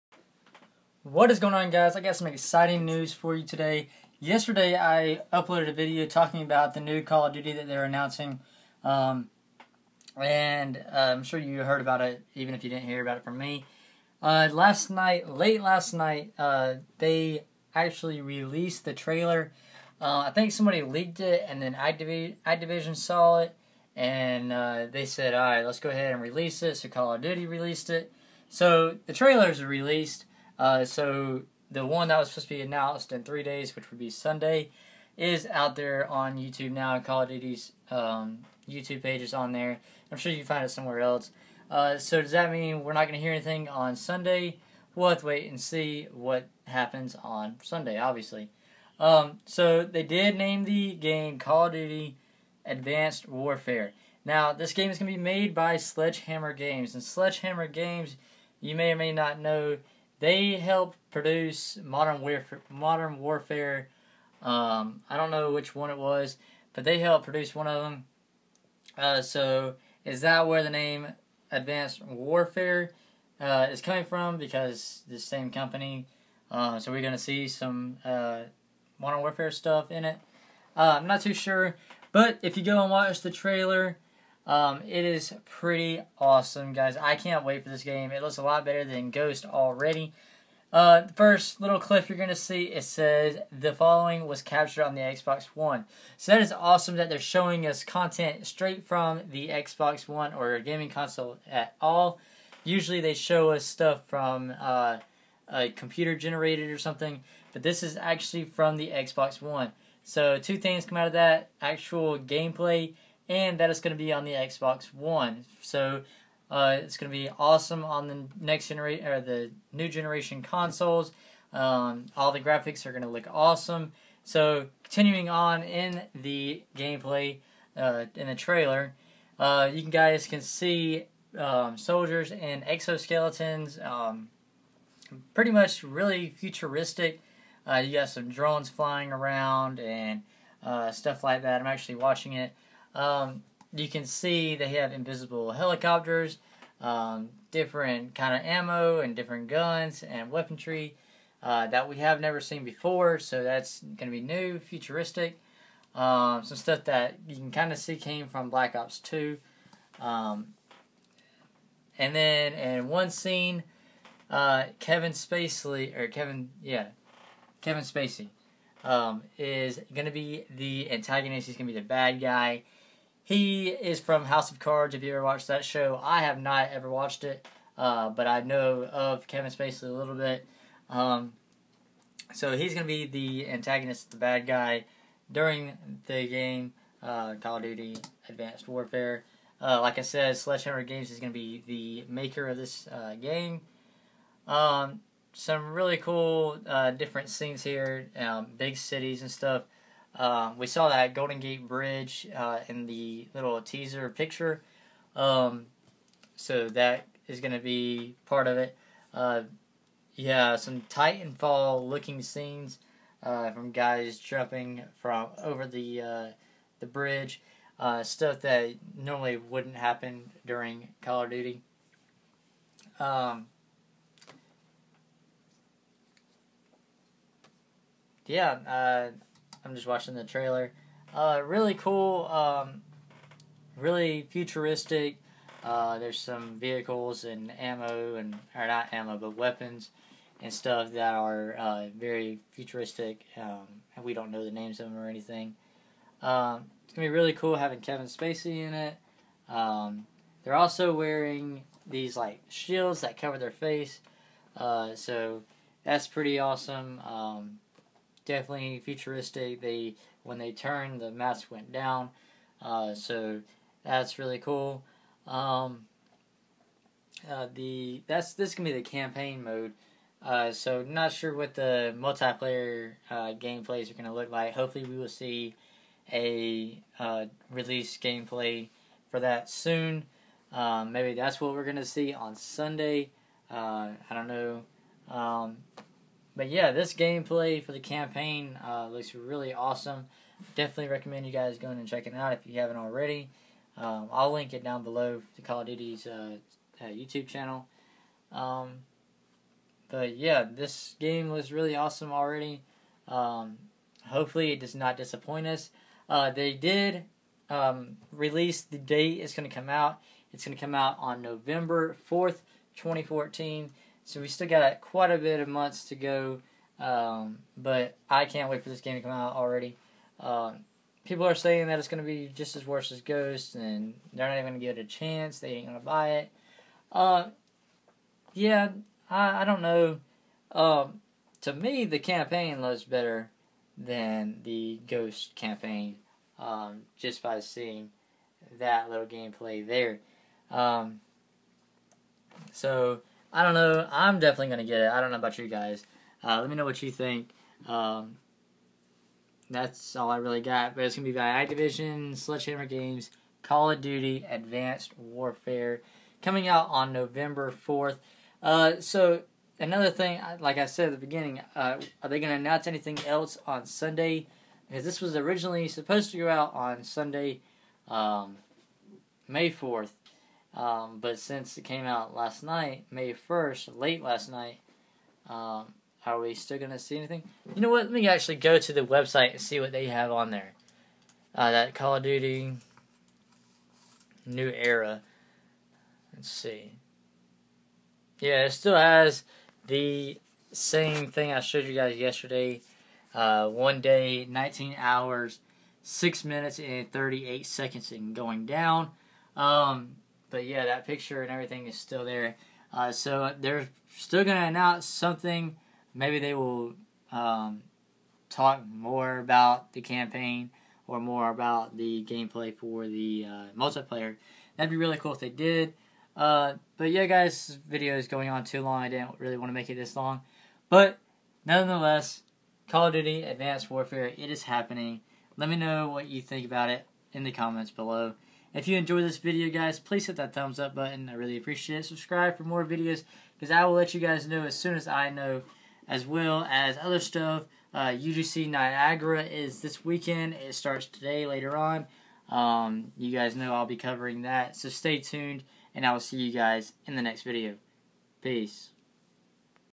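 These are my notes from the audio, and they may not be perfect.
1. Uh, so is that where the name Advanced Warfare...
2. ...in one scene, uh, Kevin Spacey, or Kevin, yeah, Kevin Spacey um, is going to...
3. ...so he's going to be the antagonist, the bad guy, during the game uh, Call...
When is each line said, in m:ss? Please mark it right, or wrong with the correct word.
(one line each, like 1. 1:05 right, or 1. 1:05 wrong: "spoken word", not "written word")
1. 1:08 right
2. 2:42 right
3. 3:02 right.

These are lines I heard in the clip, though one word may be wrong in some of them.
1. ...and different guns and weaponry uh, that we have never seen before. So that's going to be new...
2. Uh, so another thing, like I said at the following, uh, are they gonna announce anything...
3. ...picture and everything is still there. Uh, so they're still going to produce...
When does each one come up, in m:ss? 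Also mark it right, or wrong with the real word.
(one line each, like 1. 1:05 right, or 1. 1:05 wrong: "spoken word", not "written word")
1. 2:28 right
2. 5:58 wrong: "beginning", not "following"
3. 6:40 wrong: "announce", not "produce".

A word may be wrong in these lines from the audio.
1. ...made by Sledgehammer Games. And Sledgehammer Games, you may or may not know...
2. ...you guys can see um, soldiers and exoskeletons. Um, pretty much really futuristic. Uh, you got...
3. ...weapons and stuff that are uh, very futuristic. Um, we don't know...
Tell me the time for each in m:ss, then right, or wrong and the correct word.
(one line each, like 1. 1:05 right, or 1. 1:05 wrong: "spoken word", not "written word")
1. 0:55 right
2. 2:09 right
3. 3:59 right.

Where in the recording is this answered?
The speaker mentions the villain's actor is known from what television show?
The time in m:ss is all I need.
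2:54.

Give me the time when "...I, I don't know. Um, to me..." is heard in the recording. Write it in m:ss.
5:29.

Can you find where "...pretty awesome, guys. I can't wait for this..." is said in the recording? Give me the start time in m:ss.
1:25.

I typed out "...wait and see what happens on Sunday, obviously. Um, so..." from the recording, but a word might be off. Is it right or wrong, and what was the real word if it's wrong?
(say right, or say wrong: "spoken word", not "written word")
right.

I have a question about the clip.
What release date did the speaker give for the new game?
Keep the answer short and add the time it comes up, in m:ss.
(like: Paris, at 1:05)
November 4th, 2014, at 5:11.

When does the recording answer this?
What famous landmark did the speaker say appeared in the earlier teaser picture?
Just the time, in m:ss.
3:21.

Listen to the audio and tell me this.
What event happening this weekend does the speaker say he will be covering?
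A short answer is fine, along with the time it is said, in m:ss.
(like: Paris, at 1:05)
UGC Niagara, at 7:17.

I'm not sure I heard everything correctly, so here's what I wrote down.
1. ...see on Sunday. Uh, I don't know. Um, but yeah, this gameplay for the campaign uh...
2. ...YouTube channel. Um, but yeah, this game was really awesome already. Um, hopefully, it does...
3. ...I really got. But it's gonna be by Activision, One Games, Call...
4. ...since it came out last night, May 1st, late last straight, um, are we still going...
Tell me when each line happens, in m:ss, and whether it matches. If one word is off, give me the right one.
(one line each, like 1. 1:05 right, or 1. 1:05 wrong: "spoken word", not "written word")
1. 4:41 right
2. 4:56 right
3. 5:50 wrong: "Sledgehammer", not "One"
4. 6:11 wrong: "night", not "straight".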